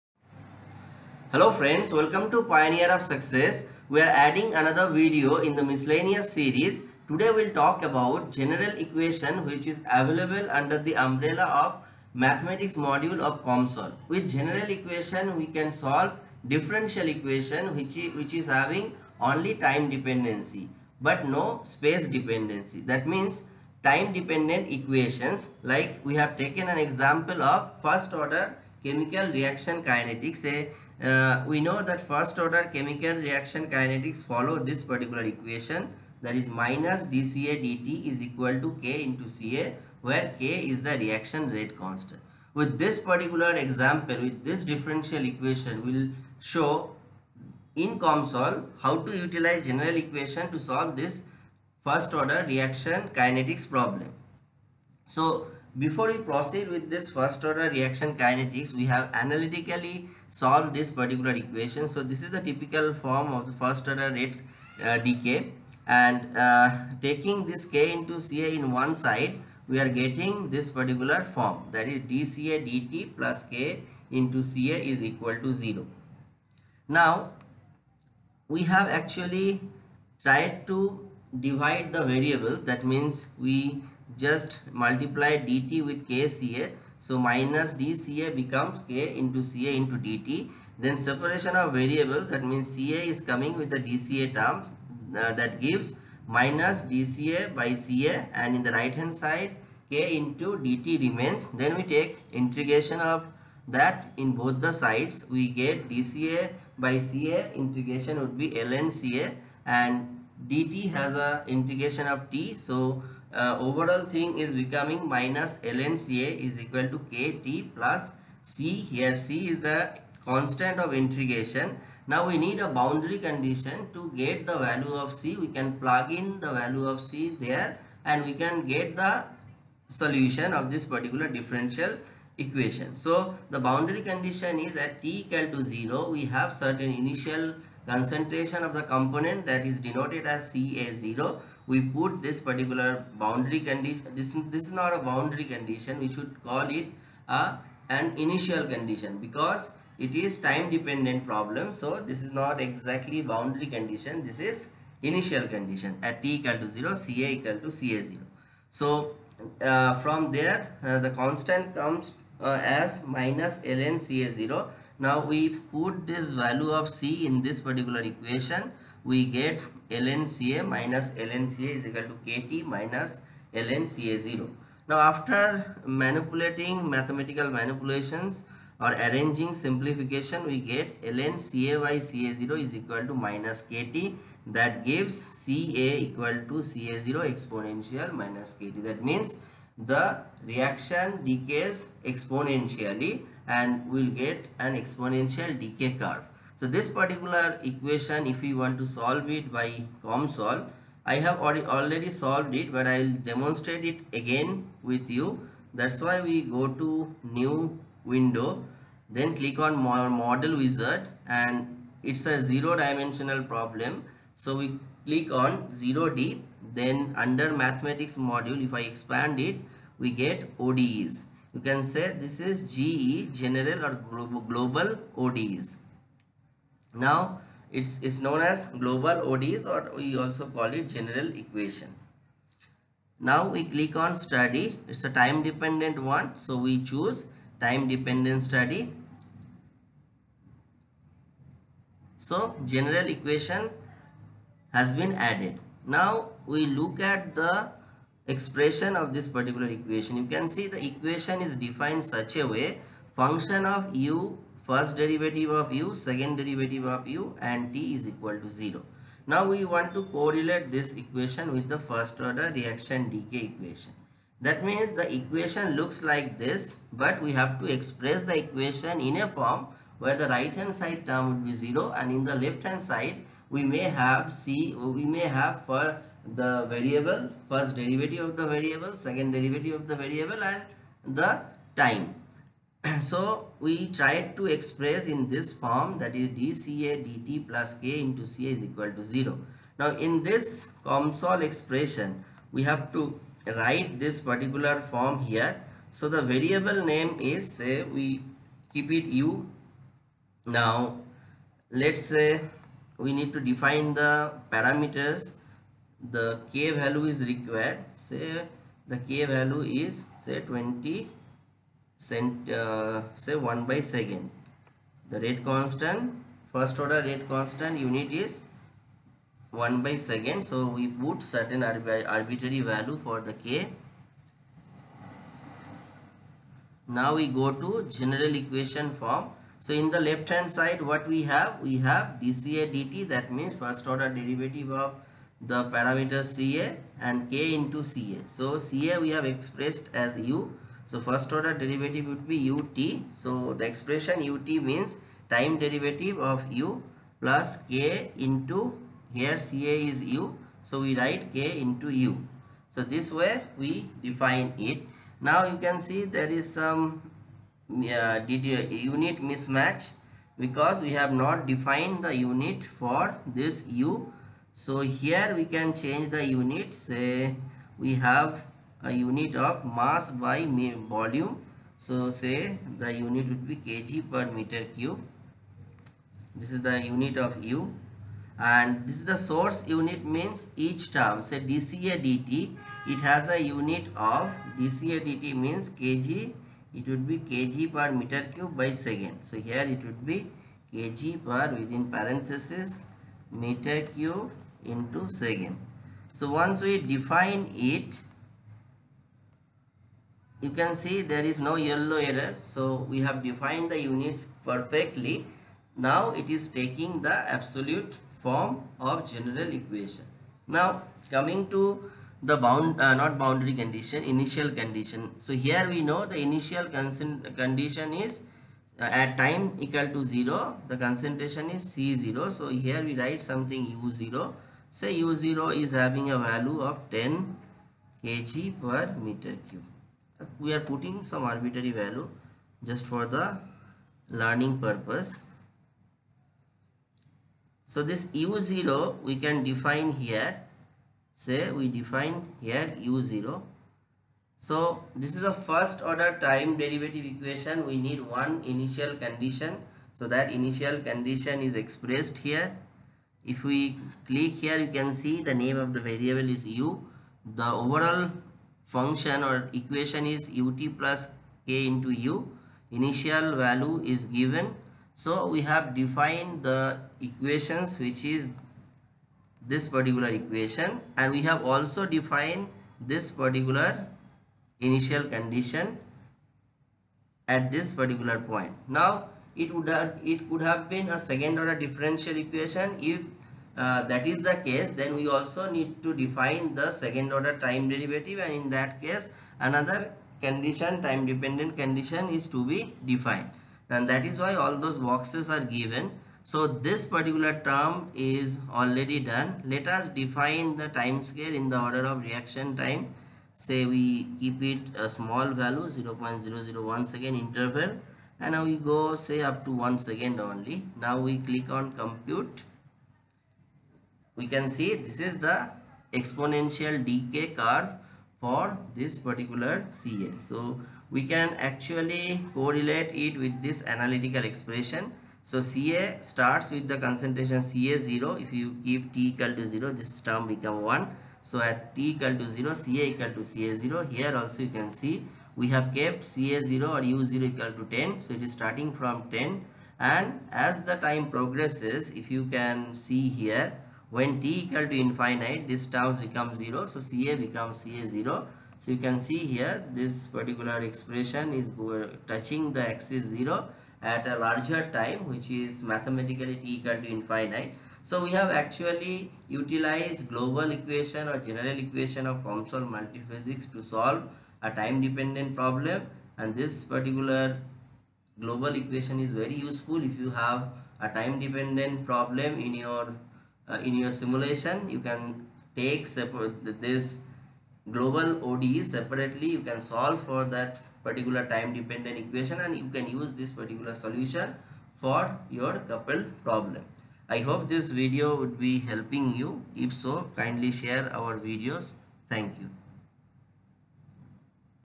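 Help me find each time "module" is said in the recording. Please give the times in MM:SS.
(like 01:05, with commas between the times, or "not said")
00:12, 03:38.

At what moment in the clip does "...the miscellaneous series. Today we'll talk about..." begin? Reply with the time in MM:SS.
00:05.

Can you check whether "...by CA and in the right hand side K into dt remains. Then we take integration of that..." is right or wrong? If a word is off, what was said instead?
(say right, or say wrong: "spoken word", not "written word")
right.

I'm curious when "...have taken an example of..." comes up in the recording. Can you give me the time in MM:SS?
00:26.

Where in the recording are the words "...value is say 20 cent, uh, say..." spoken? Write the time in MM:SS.
05:09.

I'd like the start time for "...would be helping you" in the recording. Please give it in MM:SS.
09:48.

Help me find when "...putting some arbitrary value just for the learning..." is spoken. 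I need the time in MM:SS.
07:10.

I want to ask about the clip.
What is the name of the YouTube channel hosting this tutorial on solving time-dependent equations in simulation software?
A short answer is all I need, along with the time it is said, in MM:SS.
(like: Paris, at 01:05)
Pioneer of Success, at 00:02.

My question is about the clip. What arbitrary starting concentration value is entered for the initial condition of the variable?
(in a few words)
10 kg per meter cube.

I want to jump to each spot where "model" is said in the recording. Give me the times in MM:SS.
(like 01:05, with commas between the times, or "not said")
03:29.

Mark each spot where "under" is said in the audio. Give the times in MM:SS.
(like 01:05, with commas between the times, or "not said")
00:10, 03:37.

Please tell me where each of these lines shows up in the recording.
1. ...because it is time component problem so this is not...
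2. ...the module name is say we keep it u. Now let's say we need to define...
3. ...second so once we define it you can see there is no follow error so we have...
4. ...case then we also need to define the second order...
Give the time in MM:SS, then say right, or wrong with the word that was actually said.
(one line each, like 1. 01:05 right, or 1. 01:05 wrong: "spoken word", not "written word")
1. 02:29 wrong: "dependent", not "component"
2. 04:56 wrong: "variable", not "module"
3. 06:35 wrong: "yellow", not "follow"
4. 08:04 right.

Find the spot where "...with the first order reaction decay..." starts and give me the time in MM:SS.
04:21.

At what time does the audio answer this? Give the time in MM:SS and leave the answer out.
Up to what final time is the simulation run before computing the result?
08:29.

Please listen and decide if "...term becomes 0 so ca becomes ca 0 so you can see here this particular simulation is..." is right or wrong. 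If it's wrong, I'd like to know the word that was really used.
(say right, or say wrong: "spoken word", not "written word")
wrong: "expression", not "simulation".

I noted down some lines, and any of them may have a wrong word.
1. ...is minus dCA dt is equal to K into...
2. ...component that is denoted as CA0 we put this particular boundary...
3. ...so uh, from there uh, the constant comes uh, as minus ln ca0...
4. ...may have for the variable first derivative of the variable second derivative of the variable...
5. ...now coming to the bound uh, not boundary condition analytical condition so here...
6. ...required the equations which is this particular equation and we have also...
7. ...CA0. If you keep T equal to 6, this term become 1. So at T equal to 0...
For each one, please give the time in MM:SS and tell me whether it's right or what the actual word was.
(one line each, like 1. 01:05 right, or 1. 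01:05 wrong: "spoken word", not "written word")
1. 00:36 right
2. 02:18 right
3. 02:38 right
4. 04:35 right
5. 06:50 wrong: "initial", not "analytical"
6. 07:45 wrong: "defined", not "required"
7. 08:47 wrong: "0", not "6".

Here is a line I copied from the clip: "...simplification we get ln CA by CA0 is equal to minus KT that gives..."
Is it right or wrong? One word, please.
right.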